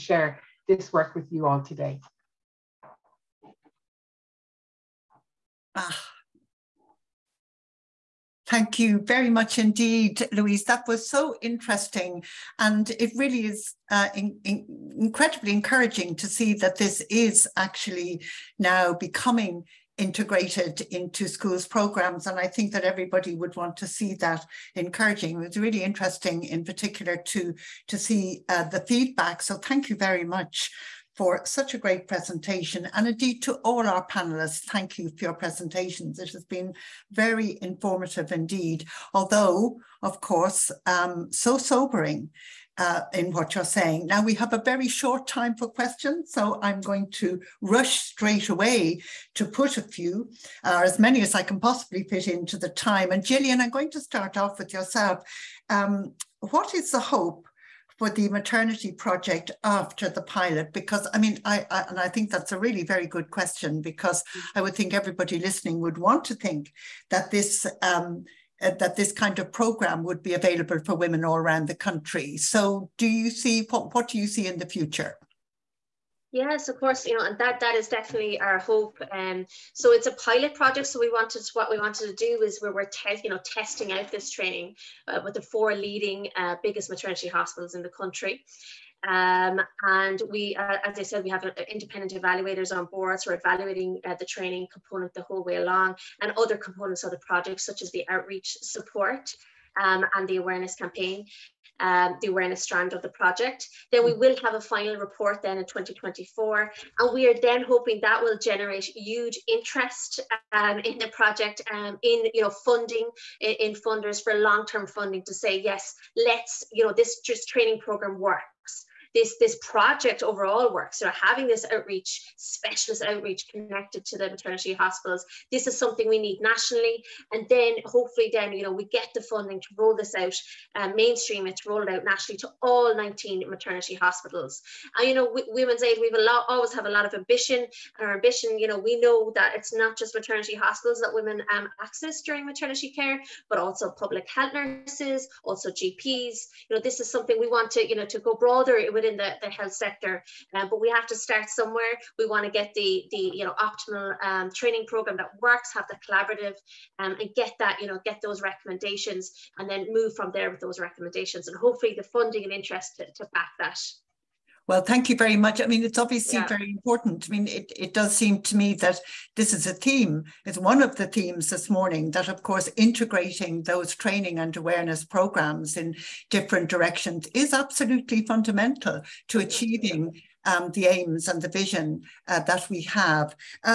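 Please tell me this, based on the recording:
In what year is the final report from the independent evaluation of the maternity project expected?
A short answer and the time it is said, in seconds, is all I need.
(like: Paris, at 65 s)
2024, at 105 s.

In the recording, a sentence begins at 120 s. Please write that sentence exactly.
So having this outreach specialist outreach connected to the maternity hospitals, this is something we need nationally.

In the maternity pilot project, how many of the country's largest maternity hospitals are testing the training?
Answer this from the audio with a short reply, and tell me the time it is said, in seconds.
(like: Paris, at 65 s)
4, at 85 s.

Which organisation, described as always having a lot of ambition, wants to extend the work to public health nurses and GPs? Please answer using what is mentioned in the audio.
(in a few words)
Women's Aid.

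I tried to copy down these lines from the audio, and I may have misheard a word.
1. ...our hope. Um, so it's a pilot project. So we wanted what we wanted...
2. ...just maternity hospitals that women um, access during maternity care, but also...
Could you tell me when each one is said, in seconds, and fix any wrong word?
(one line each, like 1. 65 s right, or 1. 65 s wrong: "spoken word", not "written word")
1. 78 s right
2. 139 s right.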